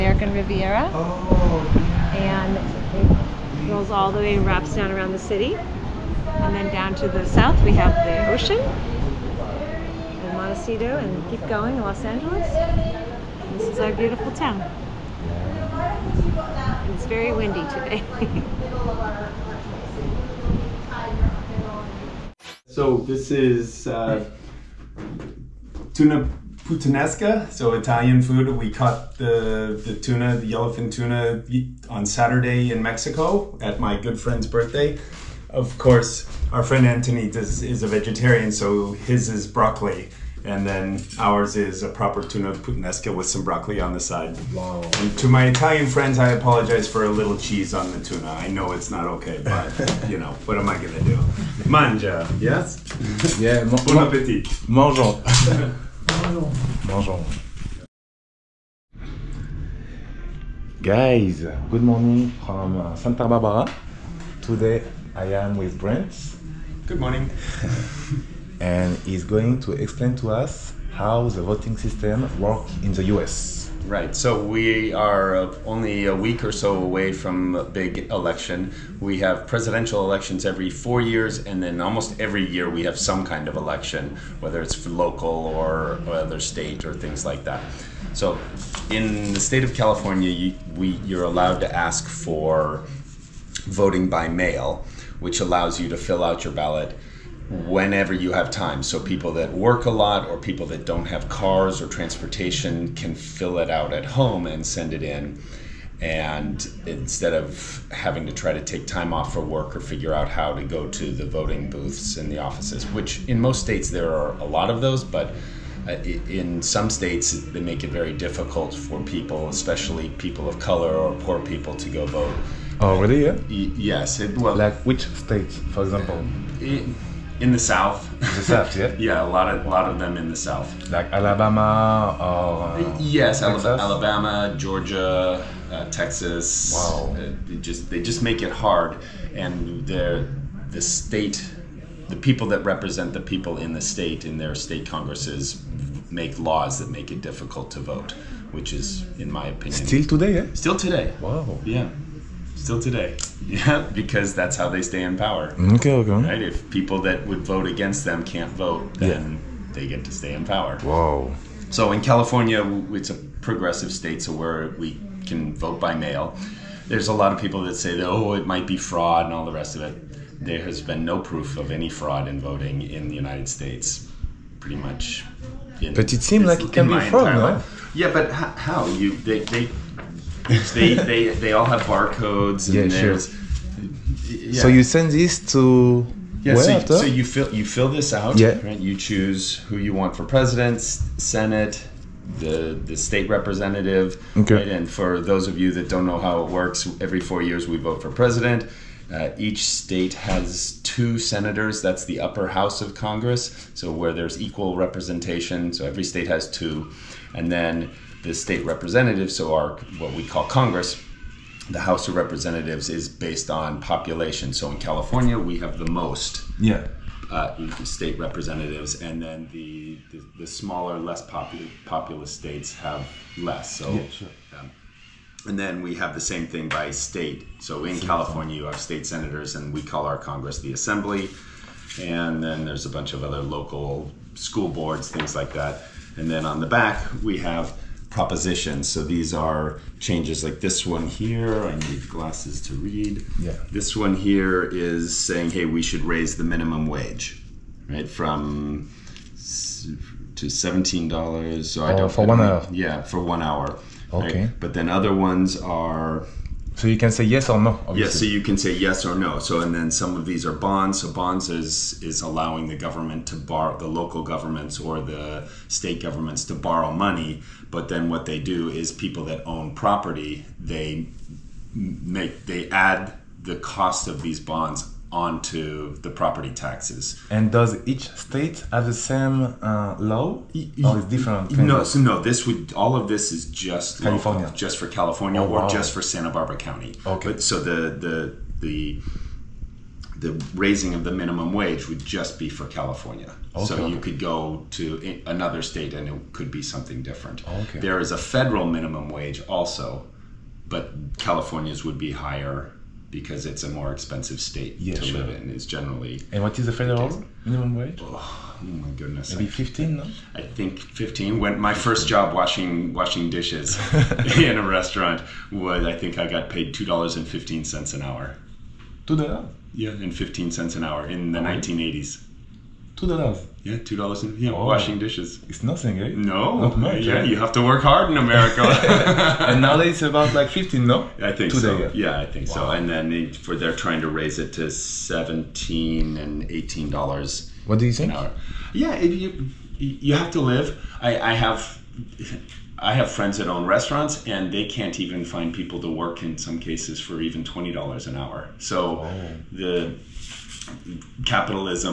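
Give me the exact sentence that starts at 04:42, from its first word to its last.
This would all of this is just California, local, just for California, oh, or wow.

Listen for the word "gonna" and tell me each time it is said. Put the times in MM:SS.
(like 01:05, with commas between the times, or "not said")
00:50.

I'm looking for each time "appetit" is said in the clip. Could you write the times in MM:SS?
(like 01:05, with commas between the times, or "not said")
00:54.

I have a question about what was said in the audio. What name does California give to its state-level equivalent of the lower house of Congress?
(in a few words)
the Assembly.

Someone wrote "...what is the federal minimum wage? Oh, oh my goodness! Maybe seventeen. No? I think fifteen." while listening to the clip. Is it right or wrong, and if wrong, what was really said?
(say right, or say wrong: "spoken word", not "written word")
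wrong: "fifteen", not "seventeen".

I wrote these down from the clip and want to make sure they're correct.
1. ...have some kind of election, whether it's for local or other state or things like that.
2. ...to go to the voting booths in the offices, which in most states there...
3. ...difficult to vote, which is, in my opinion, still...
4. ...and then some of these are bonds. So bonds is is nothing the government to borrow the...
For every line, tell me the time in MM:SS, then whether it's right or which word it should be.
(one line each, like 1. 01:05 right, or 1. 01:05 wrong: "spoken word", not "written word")
1. 01:22 right
2. 01:50 right
3. 02:27 right
4. 04:19 wrong: "allowing", not "nothing".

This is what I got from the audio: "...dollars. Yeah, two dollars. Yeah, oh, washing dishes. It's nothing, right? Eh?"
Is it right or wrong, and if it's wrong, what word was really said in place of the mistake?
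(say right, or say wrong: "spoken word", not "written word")
right.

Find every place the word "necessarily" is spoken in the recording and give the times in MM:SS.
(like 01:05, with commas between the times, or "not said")
not said.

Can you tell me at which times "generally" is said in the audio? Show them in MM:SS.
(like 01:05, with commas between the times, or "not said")
05:05.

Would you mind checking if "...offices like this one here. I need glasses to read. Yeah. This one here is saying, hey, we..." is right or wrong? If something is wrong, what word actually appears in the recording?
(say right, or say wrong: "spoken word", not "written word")
wrong: "changes", not "offices".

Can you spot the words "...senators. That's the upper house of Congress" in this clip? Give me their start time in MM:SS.
03:21.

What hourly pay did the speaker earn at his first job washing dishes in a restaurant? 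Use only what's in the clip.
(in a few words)
$2.15.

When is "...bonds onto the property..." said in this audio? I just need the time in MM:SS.
04:34.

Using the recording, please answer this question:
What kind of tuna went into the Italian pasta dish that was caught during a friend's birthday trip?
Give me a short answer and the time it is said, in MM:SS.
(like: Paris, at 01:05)
yellowfin, at 00:30.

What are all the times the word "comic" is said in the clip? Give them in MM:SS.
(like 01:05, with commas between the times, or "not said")
not said.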